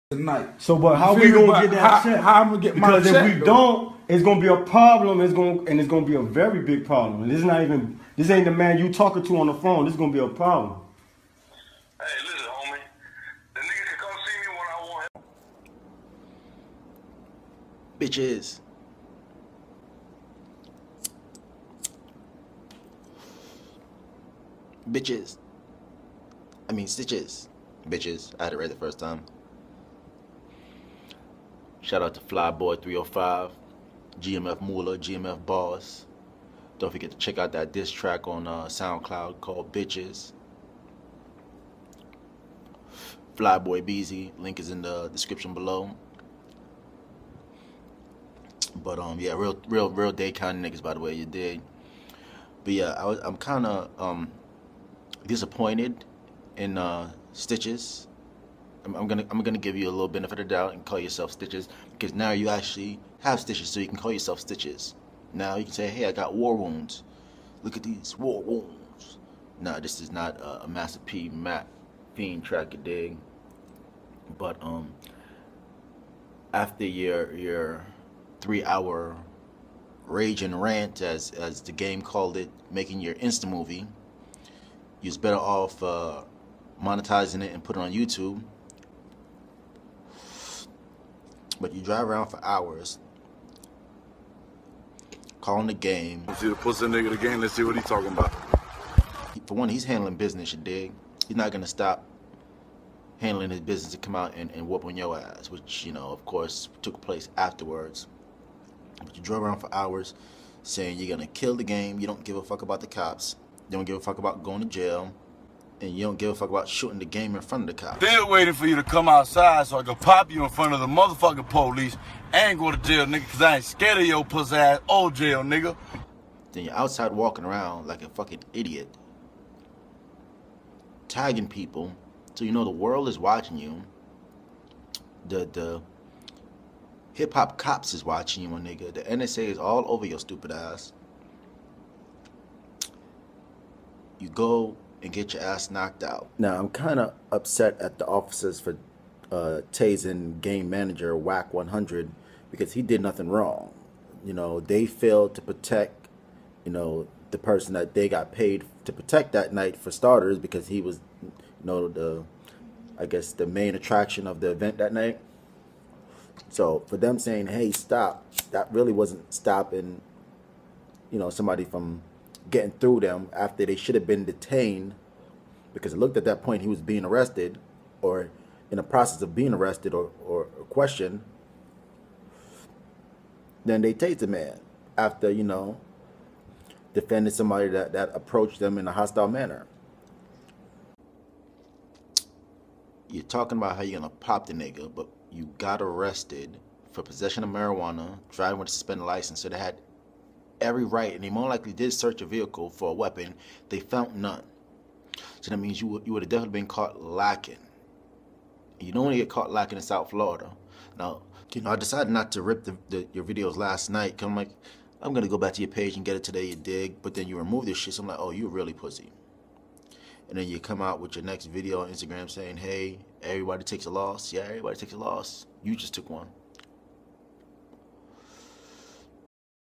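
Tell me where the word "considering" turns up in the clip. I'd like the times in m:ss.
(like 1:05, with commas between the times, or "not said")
not said.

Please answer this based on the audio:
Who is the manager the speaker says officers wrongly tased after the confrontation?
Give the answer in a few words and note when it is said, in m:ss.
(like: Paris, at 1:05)
Wack 100, at 2:31.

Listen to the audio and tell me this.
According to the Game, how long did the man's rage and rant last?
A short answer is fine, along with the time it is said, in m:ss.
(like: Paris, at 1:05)
3 hours, at 1:18.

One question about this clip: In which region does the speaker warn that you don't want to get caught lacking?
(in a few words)
South Florida.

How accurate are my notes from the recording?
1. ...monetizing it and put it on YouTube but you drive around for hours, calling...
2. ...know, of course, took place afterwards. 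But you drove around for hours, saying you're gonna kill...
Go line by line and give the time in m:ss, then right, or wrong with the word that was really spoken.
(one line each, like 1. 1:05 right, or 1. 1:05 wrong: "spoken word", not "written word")
1. 1:26 right
2. 1:45 right.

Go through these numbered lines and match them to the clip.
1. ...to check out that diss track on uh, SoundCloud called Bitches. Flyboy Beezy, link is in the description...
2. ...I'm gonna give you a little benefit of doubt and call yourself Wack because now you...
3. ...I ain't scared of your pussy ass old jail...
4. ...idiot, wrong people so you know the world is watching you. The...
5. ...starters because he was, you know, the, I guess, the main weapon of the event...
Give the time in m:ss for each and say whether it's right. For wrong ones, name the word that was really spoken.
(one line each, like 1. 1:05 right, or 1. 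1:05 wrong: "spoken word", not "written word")
1. 0:37 right
2. 0:59 wrong: "Stitches", not "Wack"
3. 2:03 right
4. 2:08 wrong: "tagging", not "wrong"
5. 2:39 wrong: "attraction", not "weapon".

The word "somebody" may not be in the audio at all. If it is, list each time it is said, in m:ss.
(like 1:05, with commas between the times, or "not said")
2:51, 3:07.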